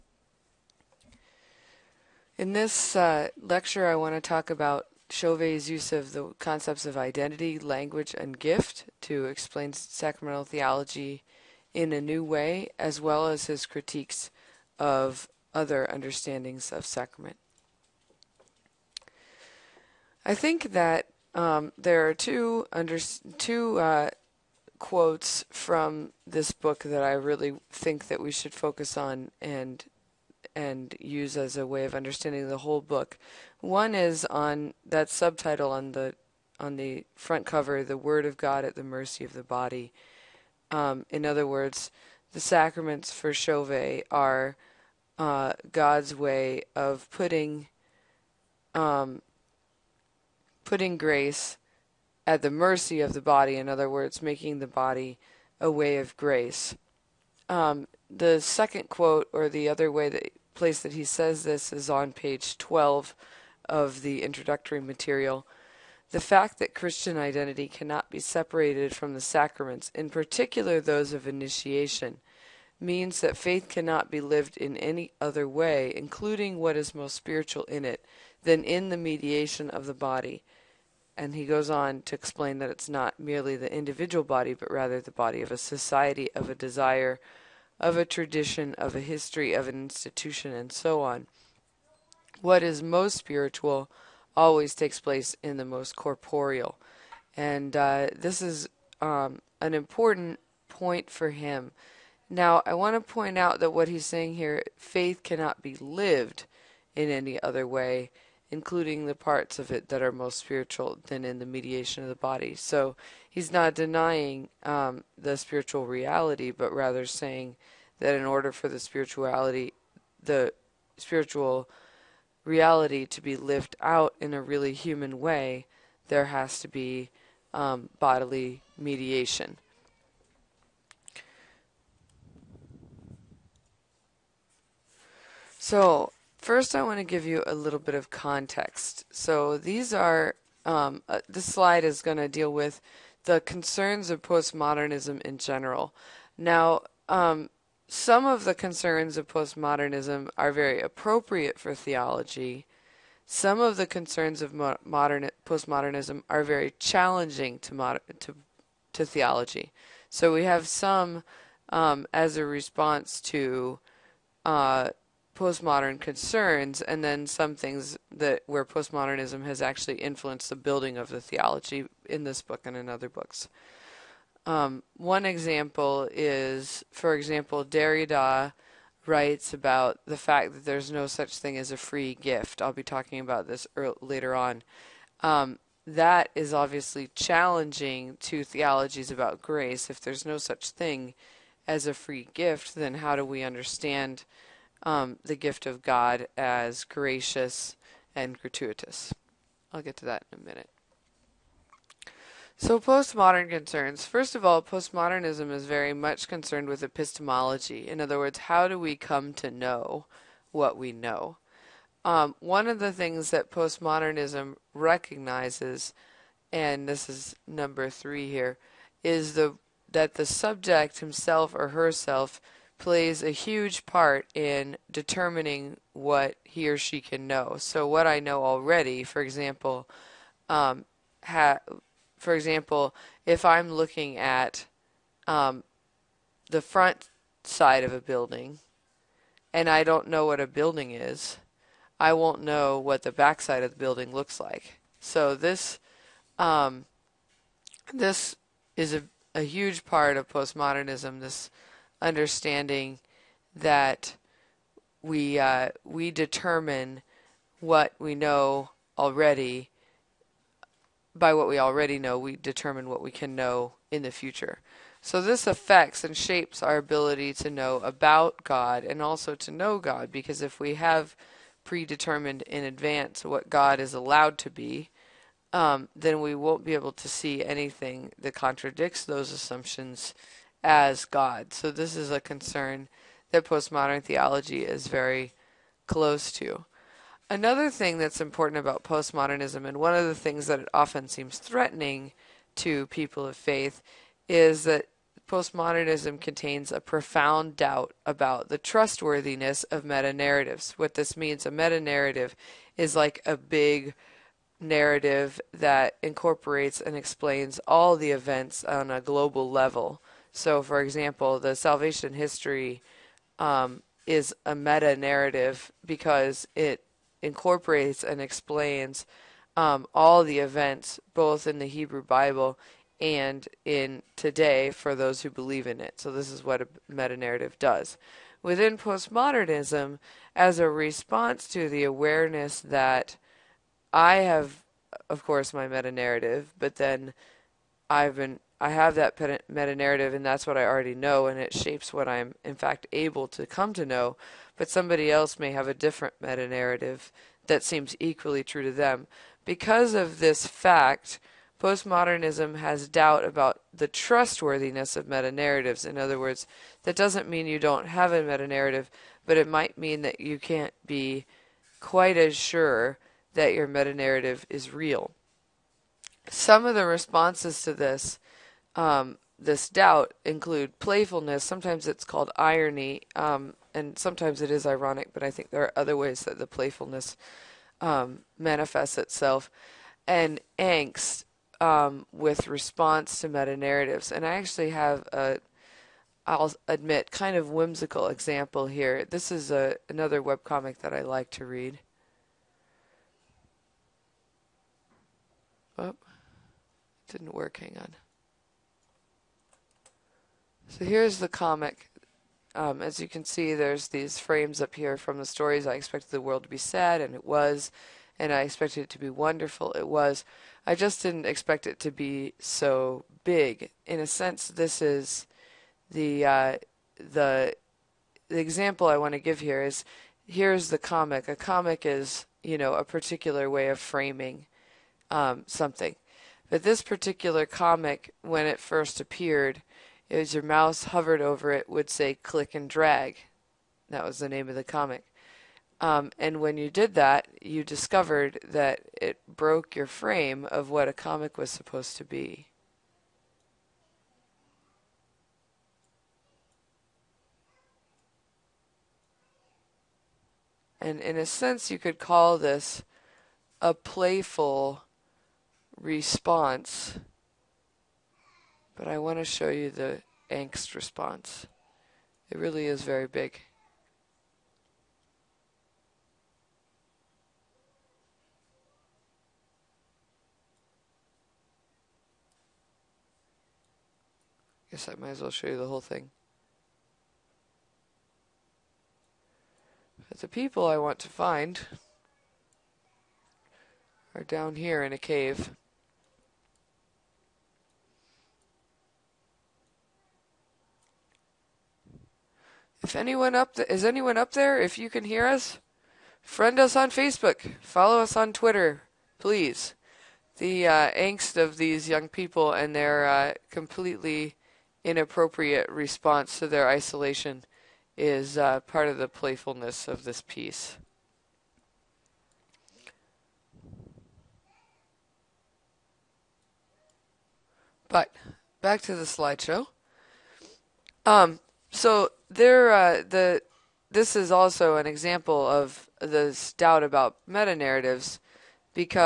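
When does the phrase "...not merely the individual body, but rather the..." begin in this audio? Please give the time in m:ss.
1:22.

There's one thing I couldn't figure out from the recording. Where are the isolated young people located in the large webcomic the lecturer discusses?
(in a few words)
In a cave.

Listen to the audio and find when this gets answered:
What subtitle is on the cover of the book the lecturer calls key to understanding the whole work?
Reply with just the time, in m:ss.
0:37.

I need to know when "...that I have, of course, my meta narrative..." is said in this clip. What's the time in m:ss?
5:32.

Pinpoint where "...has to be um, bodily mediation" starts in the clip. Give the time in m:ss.
2:06.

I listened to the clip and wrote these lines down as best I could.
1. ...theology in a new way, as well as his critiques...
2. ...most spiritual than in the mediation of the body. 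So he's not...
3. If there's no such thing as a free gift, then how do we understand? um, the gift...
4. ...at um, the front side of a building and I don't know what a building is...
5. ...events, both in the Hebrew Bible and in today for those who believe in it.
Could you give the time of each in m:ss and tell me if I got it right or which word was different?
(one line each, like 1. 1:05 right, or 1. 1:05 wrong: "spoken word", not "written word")
1. 0:10 right
2. 1:50 right
3. 3:09 right
4. 3:54 right
5. 5:20 right.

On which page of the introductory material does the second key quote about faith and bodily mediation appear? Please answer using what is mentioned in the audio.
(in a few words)
12.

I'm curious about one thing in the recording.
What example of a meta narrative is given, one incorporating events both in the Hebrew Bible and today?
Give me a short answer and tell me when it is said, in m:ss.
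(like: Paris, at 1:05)
Salvation history, at 5:11.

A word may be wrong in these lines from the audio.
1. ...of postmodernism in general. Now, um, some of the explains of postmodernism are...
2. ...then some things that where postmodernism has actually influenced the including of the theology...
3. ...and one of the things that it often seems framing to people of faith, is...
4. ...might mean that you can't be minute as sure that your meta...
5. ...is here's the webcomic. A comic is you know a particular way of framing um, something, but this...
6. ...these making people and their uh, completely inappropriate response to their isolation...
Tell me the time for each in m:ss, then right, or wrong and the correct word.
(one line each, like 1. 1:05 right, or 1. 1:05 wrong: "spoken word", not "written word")
1. 2:24 wrong: "concerns", not "explains"
2. 2:47 wrong: "building", not "including"
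3. 4:49 wrong: "threatening", not "framing"
4. 5:59 wrong: "quite", not "minute"
5. 6:59 wrong: "comic", not "webcomic"
6. 8:21 wrong: "young", not "making".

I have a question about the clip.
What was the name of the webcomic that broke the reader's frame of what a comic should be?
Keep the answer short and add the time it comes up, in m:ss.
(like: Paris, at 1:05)
Click and drag, at 7:12.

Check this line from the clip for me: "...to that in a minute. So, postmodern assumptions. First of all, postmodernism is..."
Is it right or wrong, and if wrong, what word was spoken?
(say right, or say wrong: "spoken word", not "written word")
wrong: "concerns", not "assumptions".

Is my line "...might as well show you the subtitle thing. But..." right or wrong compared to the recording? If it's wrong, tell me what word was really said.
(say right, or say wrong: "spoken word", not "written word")
wrong: "whole", not "subtitle".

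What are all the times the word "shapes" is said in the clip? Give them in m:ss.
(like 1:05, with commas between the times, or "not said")
4:26, 5:41.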